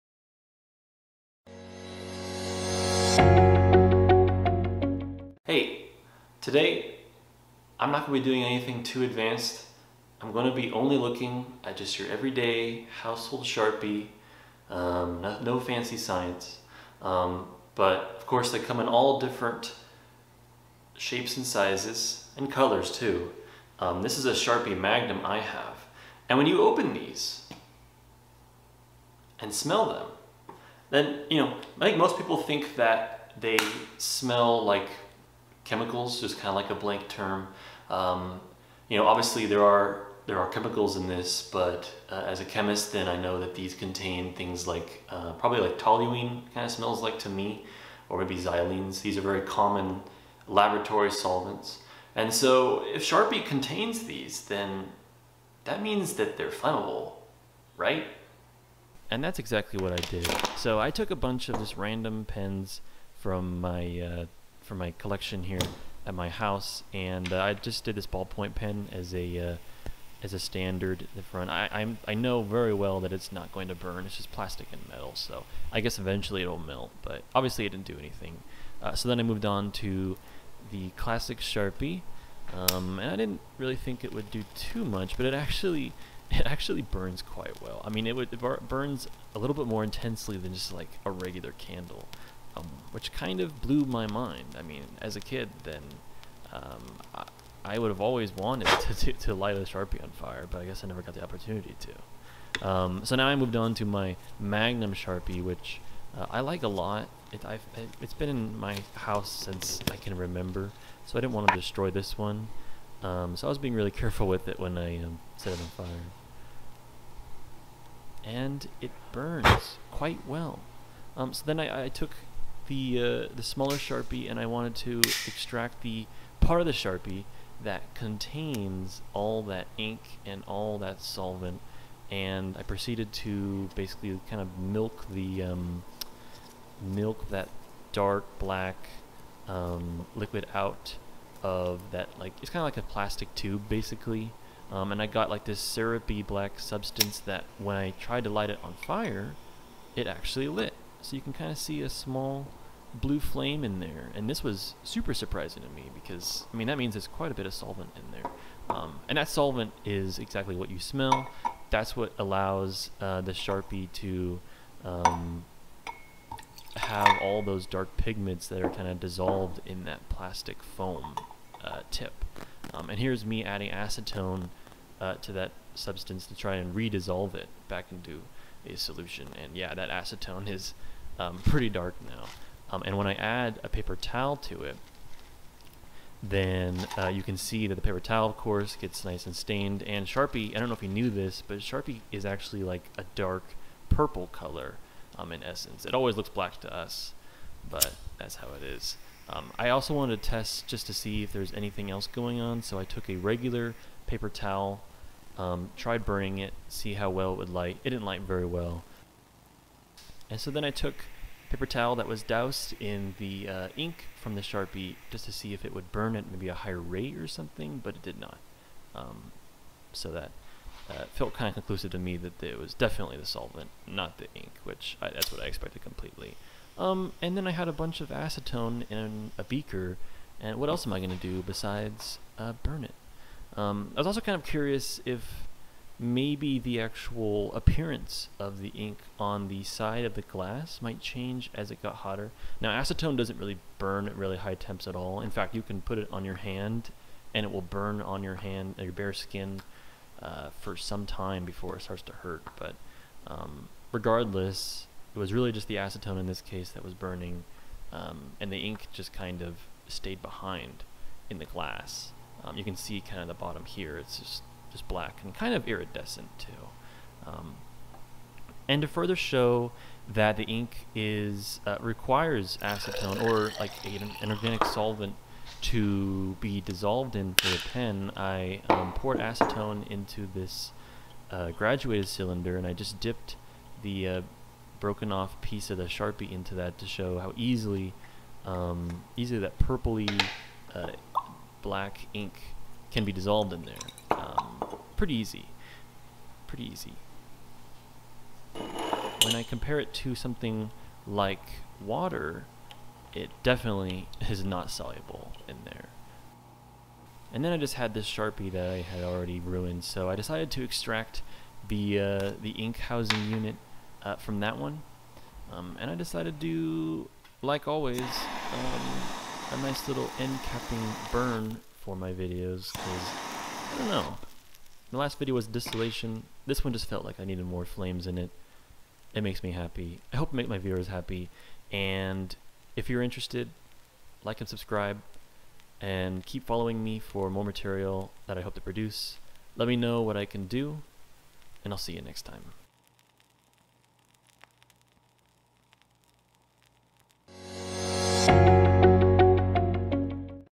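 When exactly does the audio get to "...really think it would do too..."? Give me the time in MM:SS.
01:23.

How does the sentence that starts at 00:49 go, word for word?
These are very common laboratory solvents.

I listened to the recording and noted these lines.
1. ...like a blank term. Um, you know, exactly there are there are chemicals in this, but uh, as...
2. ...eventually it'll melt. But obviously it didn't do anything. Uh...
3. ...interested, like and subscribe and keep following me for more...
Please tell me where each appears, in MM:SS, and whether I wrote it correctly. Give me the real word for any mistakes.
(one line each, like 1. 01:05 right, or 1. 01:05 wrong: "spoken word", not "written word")
1. 00:36 wrong: "obviously", not "exactly"
2. 01:15 right
3. 05:33 right.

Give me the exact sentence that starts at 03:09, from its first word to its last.
And Sharpie, I don't know if you knew this, but Sharpie is actually like a dark purple color um, in essence.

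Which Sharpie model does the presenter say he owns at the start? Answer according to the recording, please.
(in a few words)
Sharpie Magnum.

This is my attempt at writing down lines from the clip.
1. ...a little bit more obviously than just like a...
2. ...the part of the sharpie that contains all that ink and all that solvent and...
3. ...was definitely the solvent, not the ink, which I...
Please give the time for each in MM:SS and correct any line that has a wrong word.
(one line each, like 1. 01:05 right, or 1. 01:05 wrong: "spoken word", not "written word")
1. 01:29 wrong: "intensely", not "obviously"
2. 02:05 right
3. 03:42 right.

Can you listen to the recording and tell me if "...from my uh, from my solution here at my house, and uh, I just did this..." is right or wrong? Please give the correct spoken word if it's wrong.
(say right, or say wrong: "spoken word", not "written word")
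wrong: "collection", not "solution".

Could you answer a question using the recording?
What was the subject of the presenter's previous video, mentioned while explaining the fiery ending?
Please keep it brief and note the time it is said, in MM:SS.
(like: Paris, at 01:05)
distillation, at 05:25.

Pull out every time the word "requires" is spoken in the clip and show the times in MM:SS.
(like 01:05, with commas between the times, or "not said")
04:31.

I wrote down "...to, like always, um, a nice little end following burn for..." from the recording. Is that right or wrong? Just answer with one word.
wrong.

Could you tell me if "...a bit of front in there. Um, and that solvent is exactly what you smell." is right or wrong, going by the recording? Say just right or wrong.
wrong.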